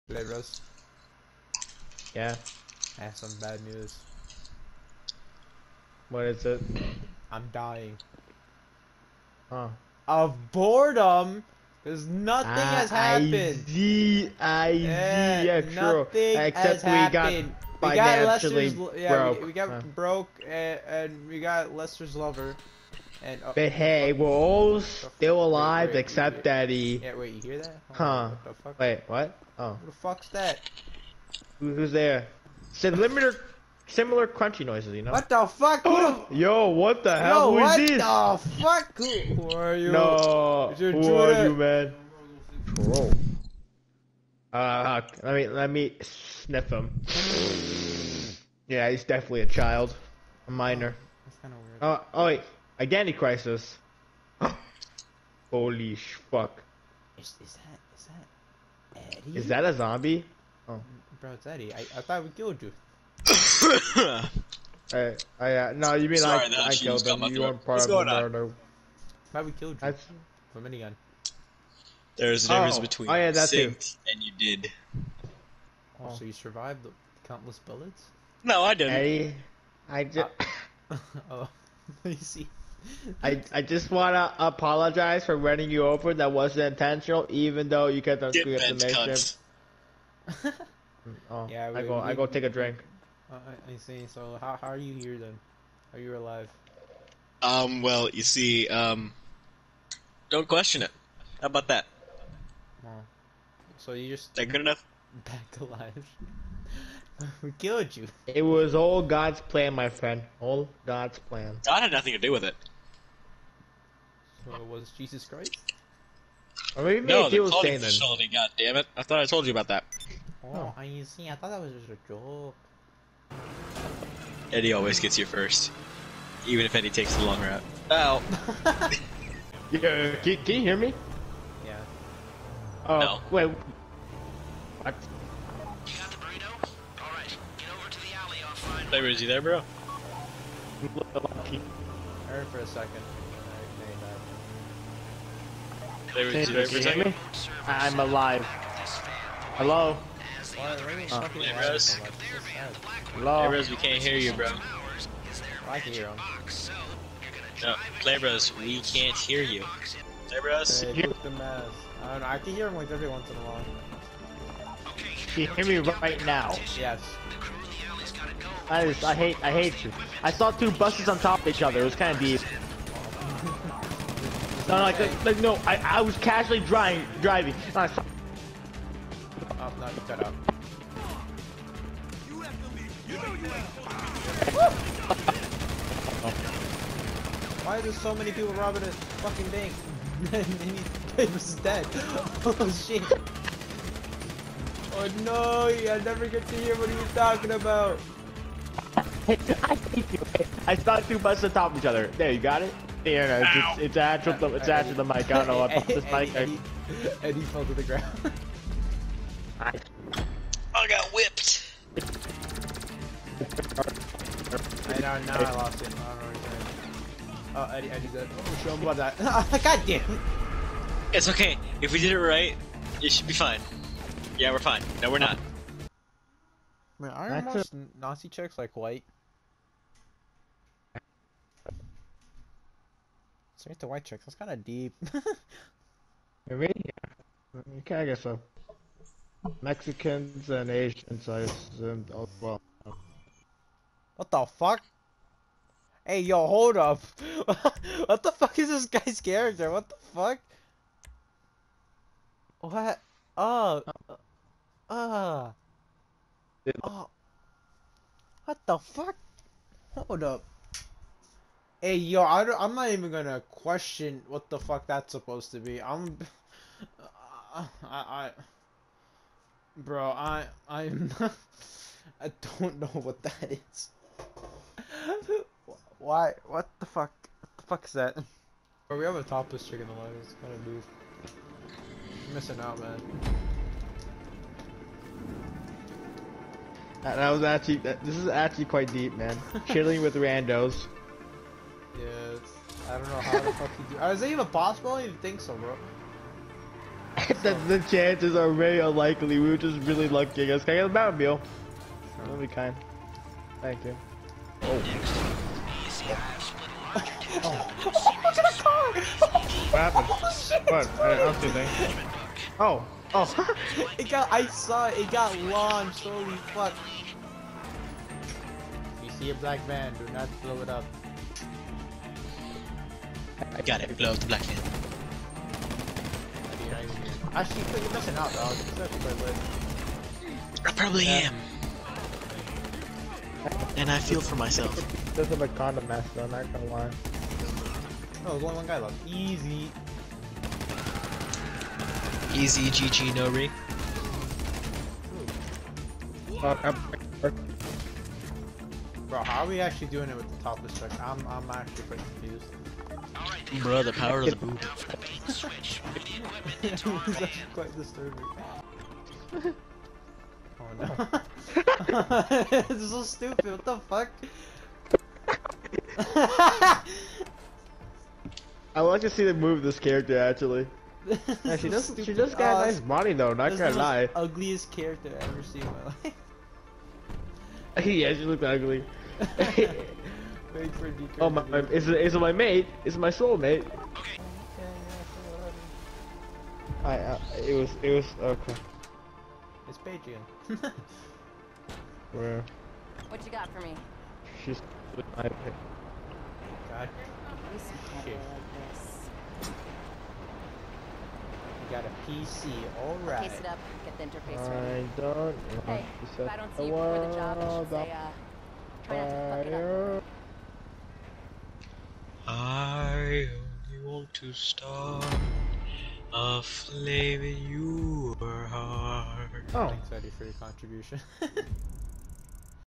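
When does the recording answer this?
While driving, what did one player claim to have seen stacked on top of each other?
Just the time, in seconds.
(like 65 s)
170 s.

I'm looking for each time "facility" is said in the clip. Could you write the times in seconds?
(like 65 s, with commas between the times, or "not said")
117 s.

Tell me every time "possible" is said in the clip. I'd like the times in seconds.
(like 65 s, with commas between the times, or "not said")
294 s.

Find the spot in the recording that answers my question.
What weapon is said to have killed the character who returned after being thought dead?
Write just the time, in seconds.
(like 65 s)
70 s.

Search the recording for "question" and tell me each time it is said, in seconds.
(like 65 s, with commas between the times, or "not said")
100 s, 263 s.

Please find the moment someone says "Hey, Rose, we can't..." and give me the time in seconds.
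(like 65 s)
153 s.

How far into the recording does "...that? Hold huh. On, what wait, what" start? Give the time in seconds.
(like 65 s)
27 s.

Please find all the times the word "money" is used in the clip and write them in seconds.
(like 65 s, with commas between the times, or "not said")
372 s.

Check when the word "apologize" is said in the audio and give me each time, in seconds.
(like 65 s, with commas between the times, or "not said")
84 s.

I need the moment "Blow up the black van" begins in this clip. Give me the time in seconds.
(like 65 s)
323 s.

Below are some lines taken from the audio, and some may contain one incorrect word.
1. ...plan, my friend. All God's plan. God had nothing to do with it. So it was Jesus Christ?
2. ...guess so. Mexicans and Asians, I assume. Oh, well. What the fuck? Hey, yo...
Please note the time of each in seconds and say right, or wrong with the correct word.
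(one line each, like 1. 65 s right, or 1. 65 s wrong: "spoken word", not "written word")
1. 109 s right
2. 238 s right.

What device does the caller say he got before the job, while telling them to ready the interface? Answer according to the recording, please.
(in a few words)
A PC.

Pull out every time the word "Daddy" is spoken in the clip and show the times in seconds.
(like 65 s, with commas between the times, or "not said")
26 s.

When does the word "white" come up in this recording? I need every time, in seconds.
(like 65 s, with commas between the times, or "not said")
228 s, 233 s.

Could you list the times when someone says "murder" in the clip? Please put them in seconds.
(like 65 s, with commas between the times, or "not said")
68 s.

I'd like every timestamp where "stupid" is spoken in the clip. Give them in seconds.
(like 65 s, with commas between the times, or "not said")
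363 s, 371 s.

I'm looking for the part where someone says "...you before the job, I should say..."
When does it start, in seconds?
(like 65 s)
406 s.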